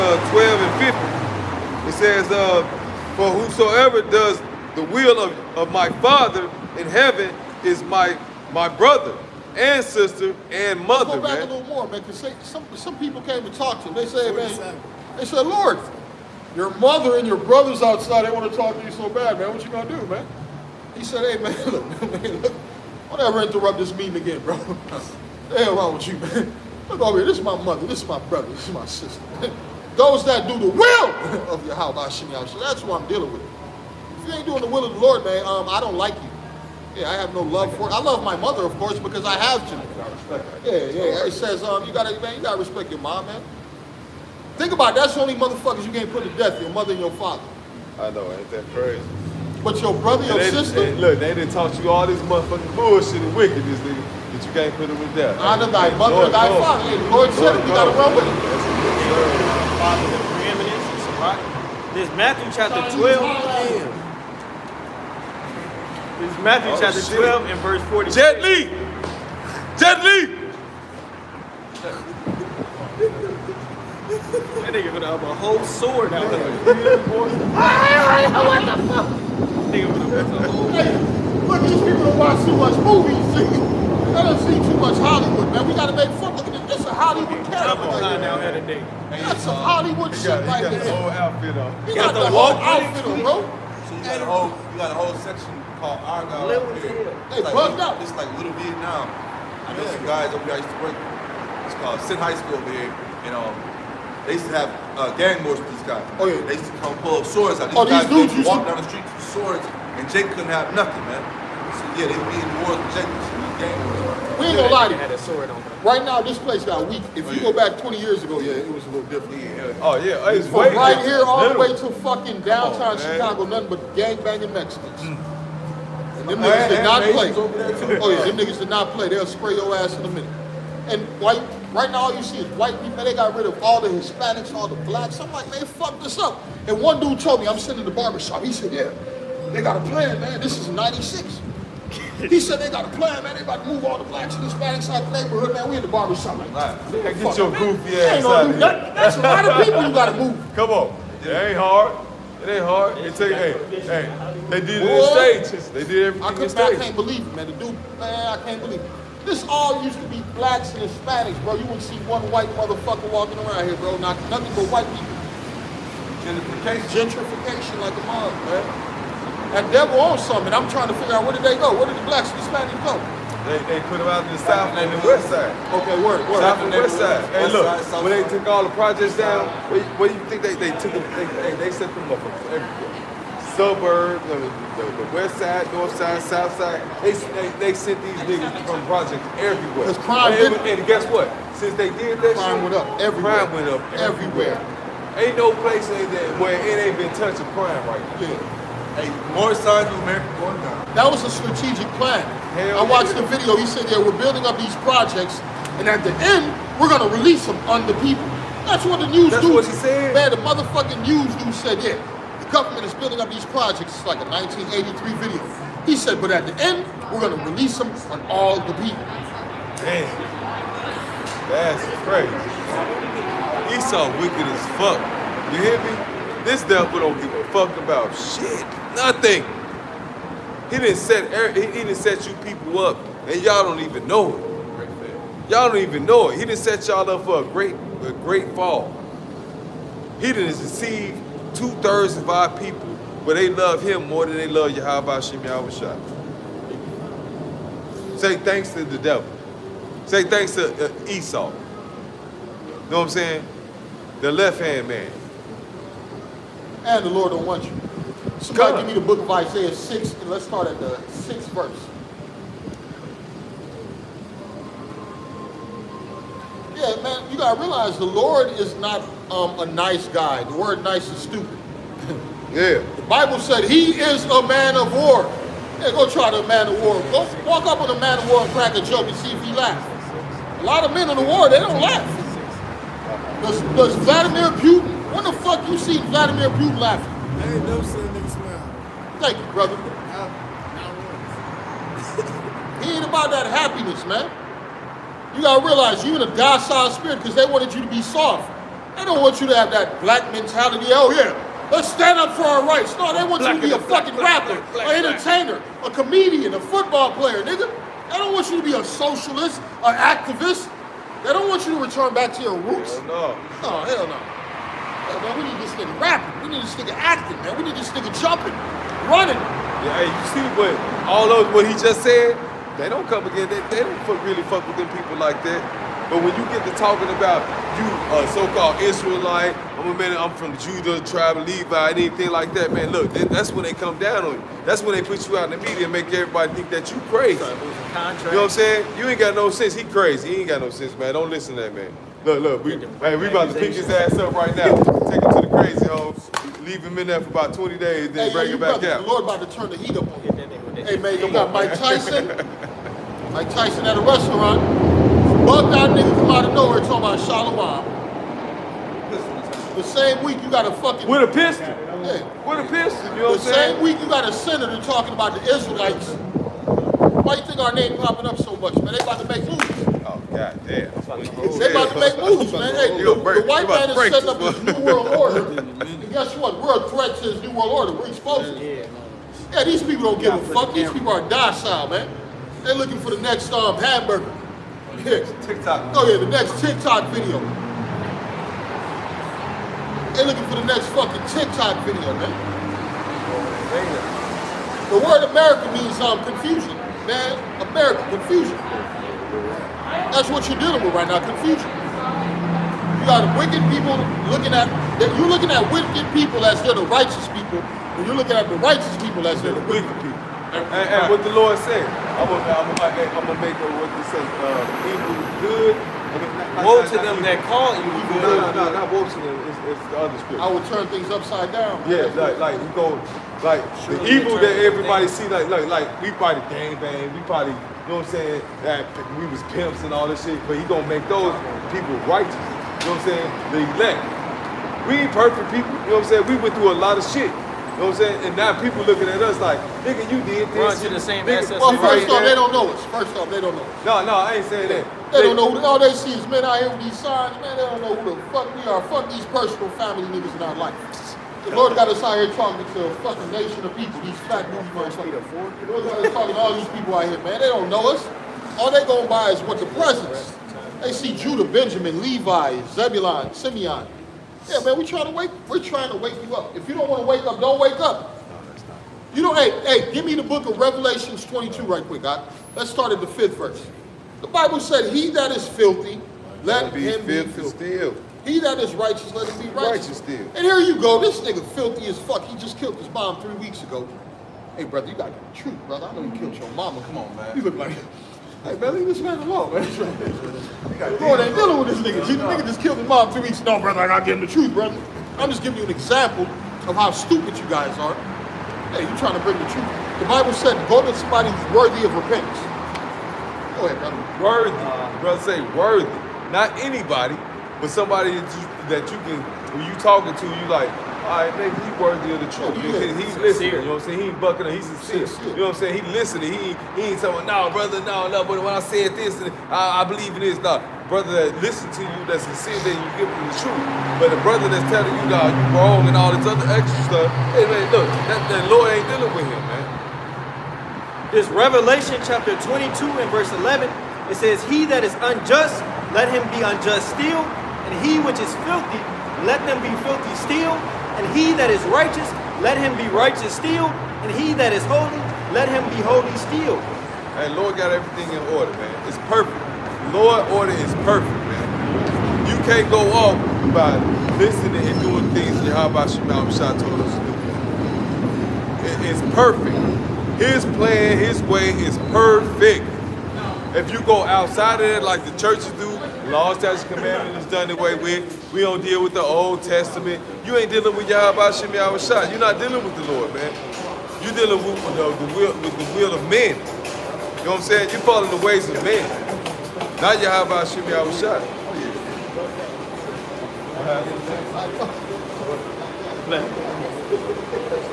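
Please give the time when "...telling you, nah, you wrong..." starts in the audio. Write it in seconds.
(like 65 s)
524 s.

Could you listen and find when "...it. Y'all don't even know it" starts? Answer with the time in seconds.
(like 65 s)
234 s.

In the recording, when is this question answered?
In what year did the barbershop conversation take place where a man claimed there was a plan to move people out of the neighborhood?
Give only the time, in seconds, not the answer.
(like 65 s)
140 s.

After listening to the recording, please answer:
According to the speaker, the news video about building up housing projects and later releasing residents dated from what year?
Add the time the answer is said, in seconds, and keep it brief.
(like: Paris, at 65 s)
1983, at 214 s.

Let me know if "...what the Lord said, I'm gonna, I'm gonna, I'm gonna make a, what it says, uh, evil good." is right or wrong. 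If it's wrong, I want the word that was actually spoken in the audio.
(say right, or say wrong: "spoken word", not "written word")
right.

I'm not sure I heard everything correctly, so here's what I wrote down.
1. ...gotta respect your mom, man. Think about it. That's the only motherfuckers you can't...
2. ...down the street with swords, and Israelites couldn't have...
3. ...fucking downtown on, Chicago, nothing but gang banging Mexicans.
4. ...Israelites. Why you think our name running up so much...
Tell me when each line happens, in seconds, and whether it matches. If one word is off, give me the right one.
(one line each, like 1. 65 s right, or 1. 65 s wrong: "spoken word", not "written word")
1. 42 s right
2. 108 s wrong: "Jake", not "Israelites"
3. 122 s right
4. 365 s wrong: "popping", not "running".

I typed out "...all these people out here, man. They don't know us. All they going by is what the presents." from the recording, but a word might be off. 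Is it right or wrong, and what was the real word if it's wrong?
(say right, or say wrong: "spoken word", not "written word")
right.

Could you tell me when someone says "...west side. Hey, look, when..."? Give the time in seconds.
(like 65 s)
176 s.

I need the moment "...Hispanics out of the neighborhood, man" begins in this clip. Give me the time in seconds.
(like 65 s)
144 s.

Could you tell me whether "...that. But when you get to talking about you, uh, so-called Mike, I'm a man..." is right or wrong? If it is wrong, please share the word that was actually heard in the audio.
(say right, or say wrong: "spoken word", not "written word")
wrong: "Israelite", not "Mike".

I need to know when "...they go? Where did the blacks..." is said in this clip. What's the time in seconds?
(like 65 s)
171 s.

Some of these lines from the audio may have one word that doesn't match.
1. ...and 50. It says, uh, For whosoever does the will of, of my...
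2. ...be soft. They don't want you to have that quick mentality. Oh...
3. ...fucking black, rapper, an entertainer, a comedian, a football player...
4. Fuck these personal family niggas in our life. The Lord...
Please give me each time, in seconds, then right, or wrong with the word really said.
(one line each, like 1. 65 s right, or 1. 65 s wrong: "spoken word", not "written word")
1. 0 s right
2. 297 s wrong: "black", not "quick"
3. 304 s right
4. 448 s right.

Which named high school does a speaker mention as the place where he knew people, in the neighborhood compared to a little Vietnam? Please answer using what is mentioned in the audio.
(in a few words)
Senn High School.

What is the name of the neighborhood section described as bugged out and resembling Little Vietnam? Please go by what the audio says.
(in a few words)
Argyle.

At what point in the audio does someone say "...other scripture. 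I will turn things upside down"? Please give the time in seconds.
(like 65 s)
419 s.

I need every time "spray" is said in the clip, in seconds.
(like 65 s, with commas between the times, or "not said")
129 s.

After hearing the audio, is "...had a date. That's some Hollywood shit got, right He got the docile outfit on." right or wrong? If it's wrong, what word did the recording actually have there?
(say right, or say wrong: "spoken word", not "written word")
wrong: "whole", not "docile".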